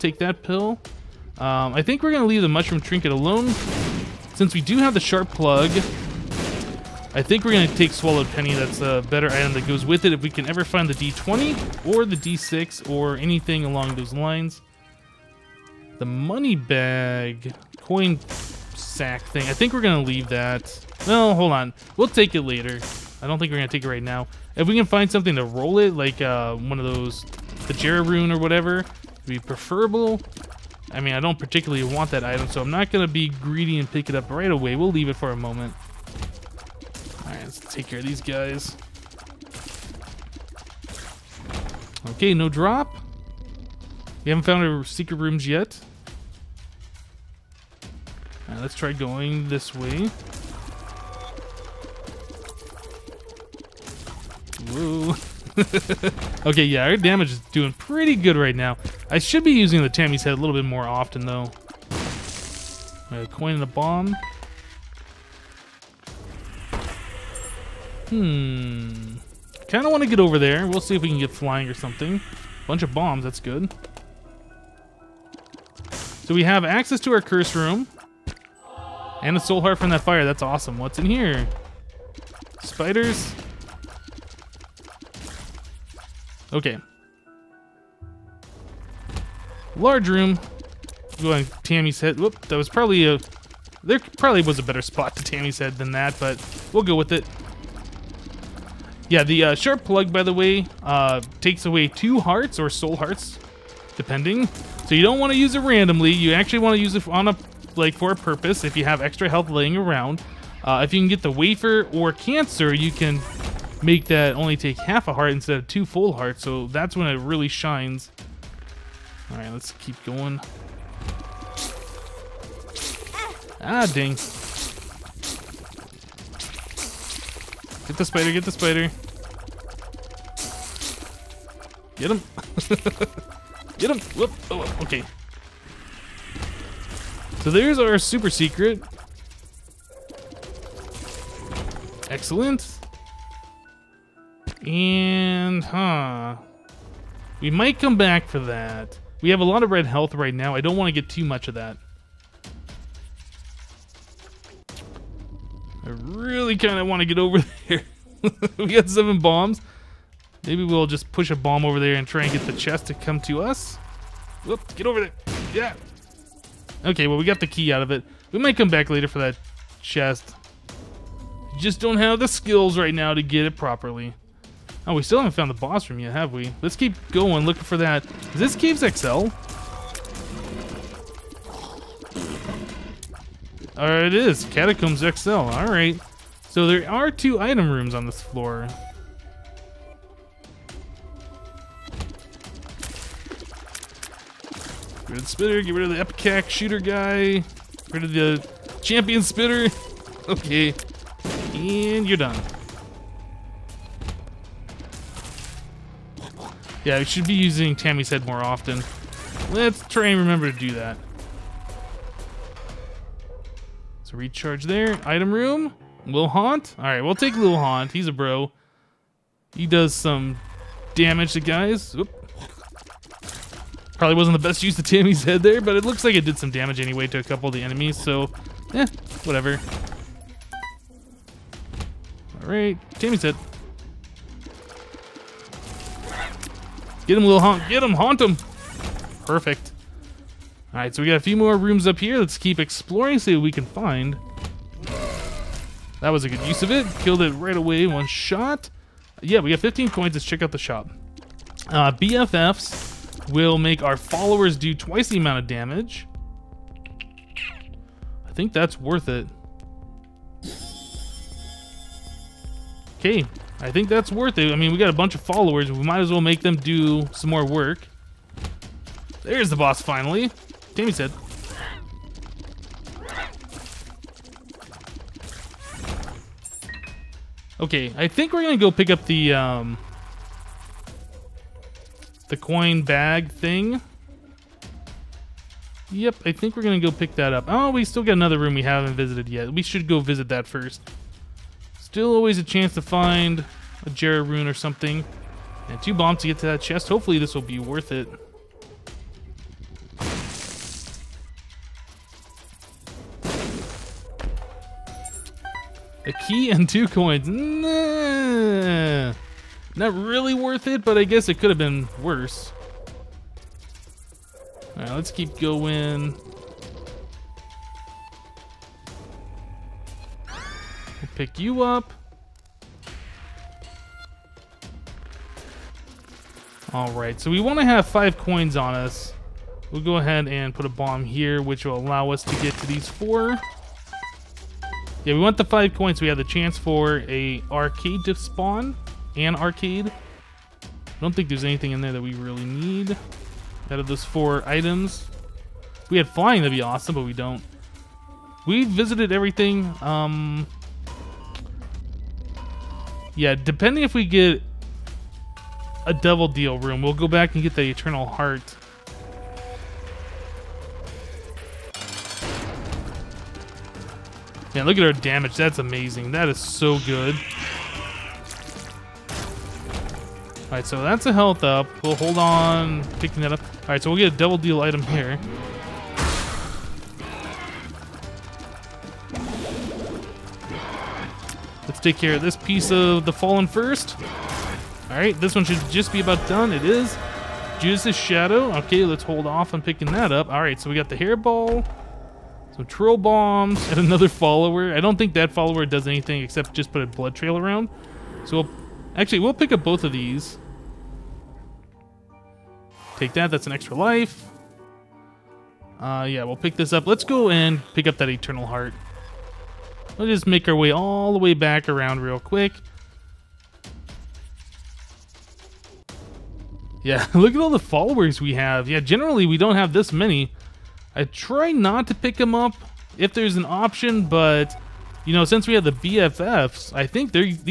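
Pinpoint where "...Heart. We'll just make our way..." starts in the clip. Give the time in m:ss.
6:48.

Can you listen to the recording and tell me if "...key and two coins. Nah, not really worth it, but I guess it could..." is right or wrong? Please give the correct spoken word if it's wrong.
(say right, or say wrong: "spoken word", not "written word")
right.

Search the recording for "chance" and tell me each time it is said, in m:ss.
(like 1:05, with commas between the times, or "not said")
4:52, 5:36.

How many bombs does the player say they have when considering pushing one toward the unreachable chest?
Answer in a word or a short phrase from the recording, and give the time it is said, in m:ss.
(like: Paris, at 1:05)
7, at 2:38.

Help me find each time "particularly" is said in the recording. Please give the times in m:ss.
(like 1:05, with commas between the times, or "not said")
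0:31.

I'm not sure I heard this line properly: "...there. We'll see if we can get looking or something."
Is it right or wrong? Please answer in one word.
wrong.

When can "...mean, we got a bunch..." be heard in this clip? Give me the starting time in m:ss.
4:24.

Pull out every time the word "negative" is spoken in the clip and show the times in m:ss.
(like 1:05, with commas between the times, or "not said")
not said.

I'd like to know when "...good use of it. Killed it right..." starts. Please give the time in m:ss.
4:06.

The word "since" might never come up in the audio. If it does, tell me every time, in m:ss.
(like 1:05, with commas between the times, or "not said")
0:04, 7:05.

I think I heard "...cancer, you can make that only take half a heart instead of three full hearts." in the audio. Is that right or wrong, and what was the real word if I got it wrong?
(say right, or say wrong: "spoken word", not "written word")
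wrong: "two", not "three".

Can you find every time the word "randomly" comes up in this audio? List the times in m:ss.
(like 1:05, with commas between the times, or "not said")
1:45.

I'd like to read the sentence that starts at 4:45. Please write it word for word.
Yep, I think we're gonna go pick that up.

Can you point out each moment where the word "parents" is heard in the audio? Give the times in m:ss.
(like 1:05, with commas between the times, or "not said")
not said.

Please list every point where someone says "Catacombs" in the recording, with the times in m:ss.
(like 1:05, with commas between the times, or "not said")
3:04.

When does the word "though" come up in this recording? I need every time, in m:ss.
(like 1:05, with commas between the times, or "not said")
1:01.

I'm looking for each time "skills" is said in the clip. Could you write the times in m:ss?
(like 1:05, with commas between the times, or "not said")
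2:52.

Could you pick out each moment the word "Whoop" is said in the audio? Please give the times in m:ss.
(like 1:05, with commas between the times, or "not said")
1:32, 2:14, 2:44.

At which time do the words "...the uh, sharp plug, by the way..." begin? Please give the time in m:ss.
1:39.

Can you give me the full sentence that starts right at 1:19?
And a soul heart from that fire.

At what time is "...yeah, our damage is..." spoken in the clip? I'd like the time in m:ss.
0:56.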